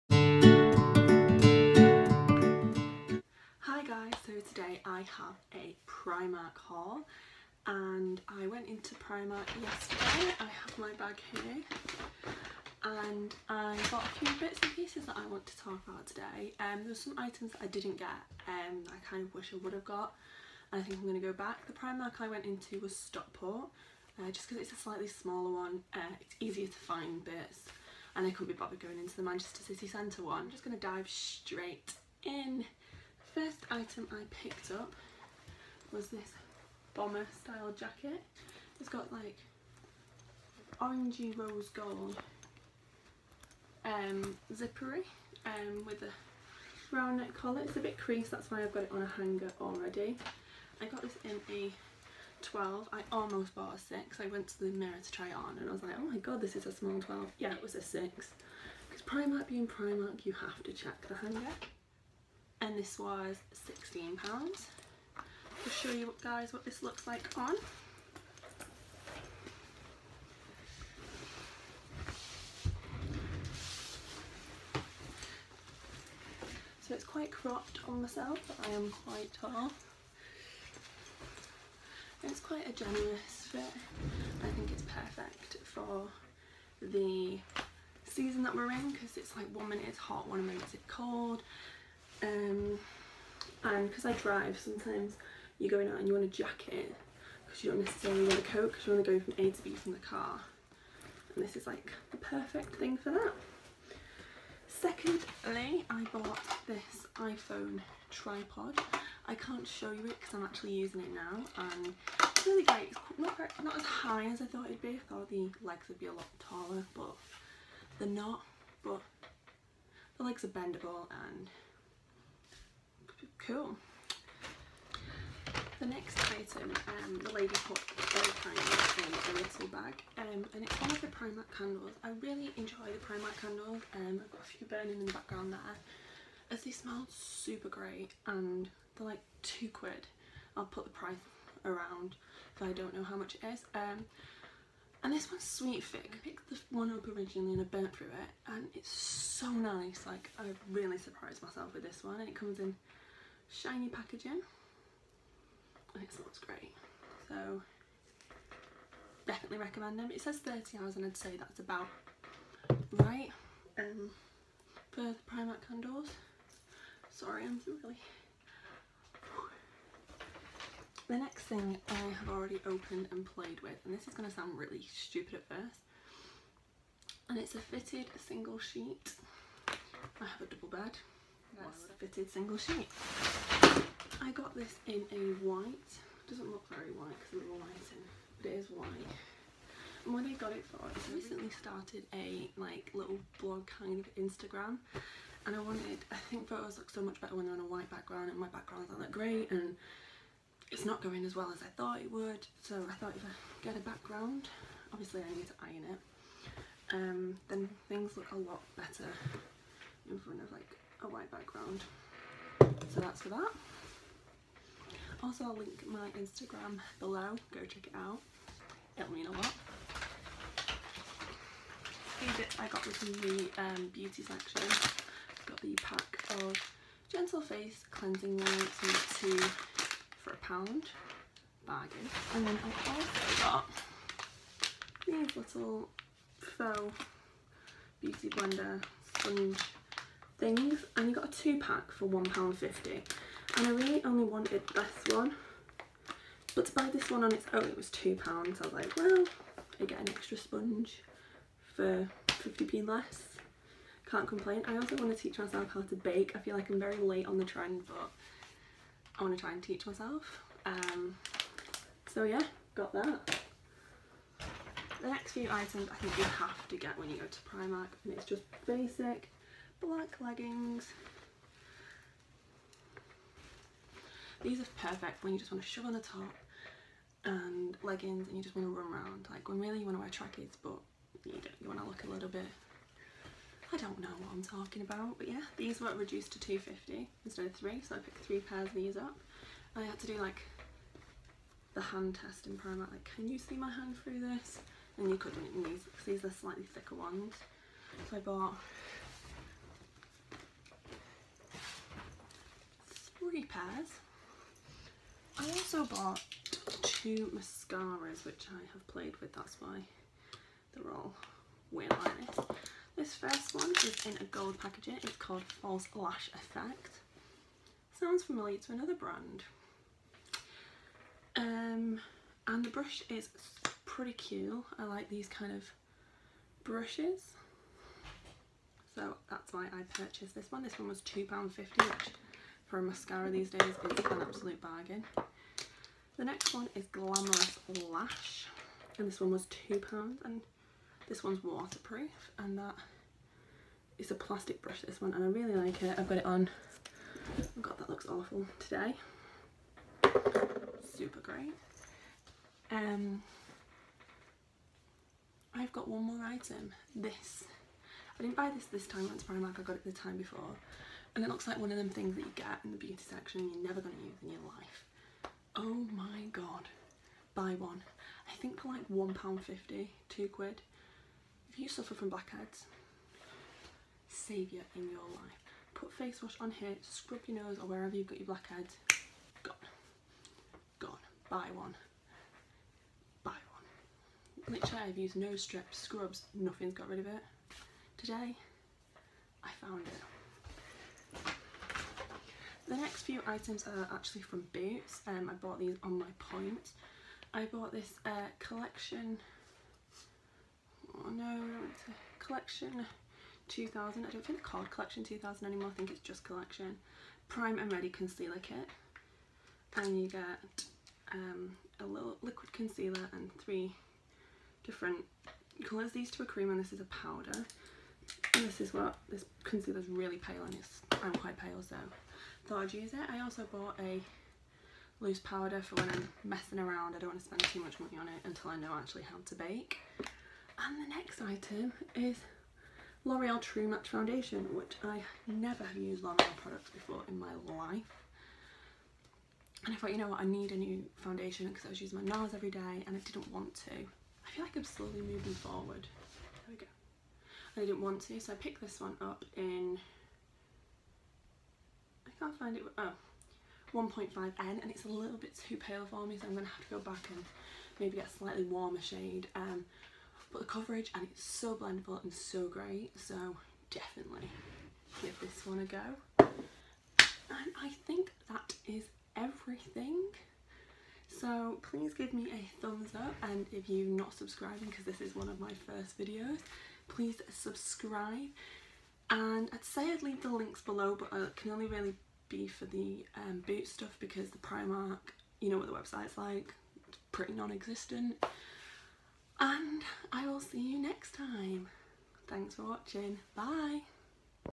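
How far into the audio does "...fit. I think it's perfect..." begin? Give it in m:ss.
1:23.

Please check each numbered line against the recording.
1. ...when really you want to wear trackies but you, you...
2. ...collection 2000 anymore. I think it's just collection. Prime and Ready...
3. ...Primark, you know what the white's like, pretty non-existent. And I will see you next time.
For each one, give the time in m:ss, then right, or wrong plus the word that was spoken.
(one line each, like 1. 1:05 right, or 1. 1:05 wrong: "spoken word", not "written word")
1. 4:39 right
2. 6:44 right
3. 8:04 wrong: "website", not "white".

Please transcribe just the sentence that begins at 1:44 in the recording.
Secondly I bought this iPhone tripod.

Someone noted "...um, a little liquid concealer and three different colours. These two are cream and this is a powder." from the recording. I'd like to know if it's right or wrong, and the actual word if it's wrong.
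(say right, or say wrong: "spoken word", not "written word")
right.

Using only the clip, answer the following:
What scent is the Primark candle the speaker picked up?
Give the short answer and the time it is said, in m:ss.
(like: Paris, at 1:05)
Sweet fig, at 2:25.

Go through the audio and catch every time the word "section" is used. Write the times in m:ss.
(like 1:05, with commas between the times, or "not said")
3:44, 6:03.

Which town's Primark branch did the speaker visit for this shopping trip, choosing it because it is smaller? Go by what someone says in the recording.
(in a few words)
Stockport.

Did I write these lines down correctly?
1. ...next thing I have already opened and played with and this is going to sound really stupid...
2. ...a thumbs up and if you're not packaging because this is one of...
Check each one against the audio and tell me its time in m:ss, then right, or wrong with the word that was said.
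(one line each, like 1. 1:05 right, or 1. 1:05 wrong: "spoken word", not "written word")
1. 2:51 right
2. 7:52 wrong: "subscribing", not "packaging".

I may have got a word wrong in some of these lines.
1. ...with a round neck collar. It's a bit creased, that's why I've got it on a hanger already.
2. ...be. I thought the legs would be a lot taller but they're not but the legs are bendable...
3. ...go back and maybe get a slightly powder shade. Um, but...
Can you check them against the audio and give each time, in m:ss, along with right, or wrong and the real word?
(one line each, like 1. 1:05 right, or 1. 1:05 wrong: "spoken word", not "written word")
1. 0:45 right
2. 1:54 right
3. 7:36 wrong: "warmer", not "powder".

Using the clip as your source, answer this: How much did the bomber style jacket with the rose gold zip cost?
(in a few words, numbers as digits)
£16.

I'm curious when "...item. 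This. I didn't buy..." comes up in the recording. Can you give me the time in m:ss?
5:56.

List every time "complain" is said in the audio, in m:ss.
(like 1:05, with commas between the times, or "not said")
4:14.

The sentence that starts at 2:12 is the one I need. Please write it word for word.
I really enjoy the Primark candles.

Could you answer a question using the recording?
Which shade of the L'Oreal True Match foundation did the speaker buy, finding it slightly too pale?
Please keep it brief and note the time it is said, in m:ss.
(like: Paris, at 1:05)
1.5N, at 7:33.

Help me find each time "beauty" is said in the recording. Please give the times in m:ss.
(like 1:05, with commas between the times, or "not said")
3:43, 3:58, 6:02.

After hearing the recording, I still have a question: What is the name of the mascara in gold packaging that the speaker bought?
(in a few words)
False Lash Effect.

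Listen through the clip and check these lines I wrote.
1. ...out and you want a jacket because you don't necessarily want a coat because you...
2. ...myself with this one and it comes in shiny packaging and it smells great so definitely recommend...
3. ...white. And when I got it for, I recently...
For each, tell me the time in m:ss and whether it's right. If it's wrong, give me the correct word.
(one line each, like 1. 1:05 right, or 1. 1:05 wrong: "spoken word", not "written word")
1. 1:35 right
2. 2:31 right
3. 3:08 right.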